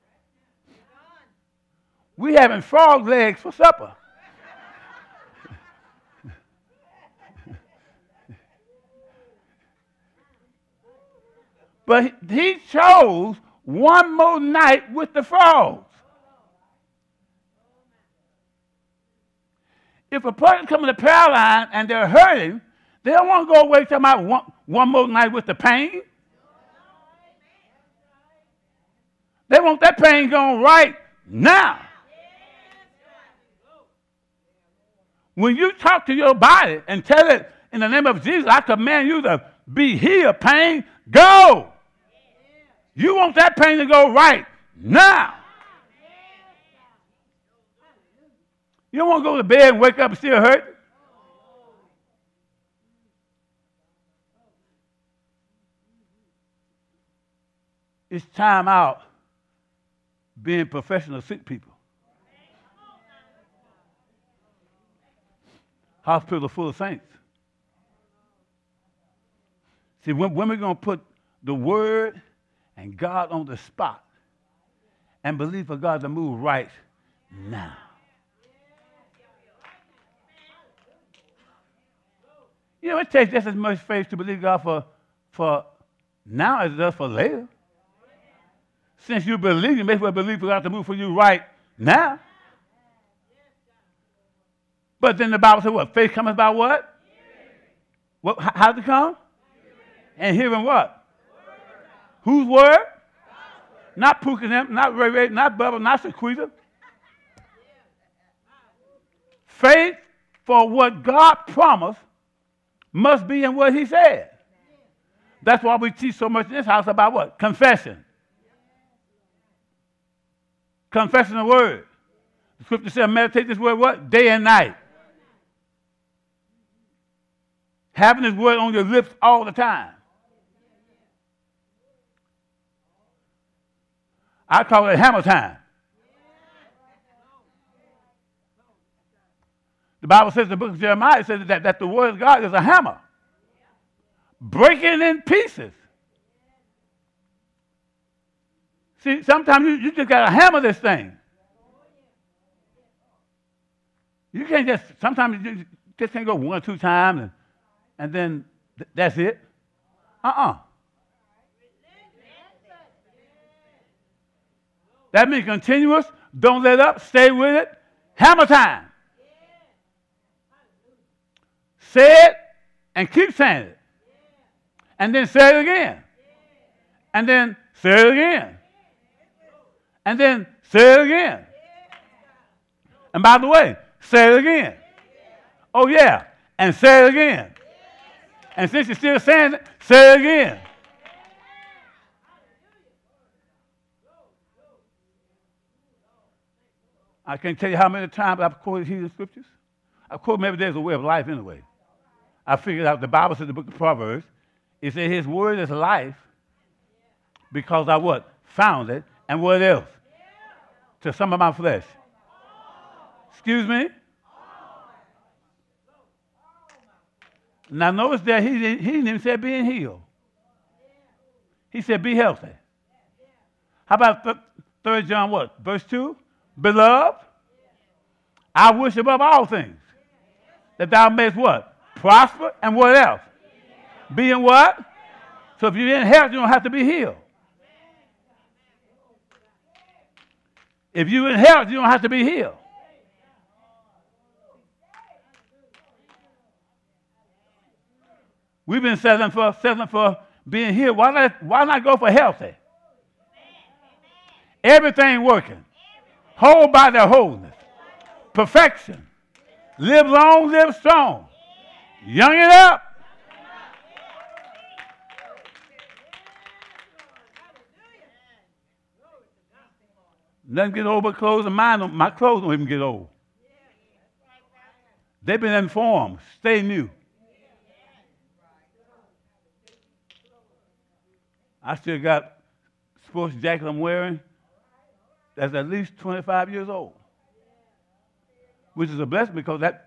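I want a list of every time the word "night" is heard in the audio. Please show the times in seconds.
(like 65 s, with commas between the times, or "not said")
14 s, 25 s, 124 s.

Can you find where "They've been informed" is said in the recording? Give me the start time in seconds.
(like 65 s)
275 s.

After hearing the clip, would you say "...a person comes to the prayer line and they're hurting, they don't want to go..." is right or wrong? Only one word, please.
right.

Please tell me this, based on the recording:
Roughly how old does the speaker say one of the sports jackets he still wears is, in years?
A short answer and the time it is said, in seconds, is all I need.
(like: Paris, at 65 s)
25, at 285 s.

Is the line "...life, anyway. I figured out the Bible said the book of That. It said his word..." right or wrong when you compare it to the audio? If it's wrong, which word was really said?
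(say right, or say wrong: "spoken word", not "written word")
wrong: "Proverbs", not "That".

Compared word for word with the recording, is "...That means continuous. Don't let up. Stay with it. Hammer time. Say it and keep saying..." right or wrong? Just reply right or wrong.
right.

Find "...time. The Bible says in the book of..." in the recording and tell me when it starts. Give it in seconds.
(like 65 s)
135 s.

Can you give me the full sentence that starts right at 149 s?
See, sometimes you, you just got to hammer this thing.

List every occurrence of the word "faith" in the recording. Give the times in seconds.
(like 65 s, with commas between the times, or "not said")
83 s, 95 s, 109 s.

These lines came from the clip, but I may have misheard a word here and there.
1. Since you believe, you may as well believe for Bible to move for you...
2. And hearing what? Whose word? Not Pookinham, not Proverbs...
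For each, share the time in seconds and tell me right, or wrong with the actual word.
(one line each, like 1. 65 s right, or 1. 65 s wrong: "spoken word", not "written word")
1. 88 s wrong: "God", not "Bible"
2. 100 s wrong: "Ray", not "Proverbs".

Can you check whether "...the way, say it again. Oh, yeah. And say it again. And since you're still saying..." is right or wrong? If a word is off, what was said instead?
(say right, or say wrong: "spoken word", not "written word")
right.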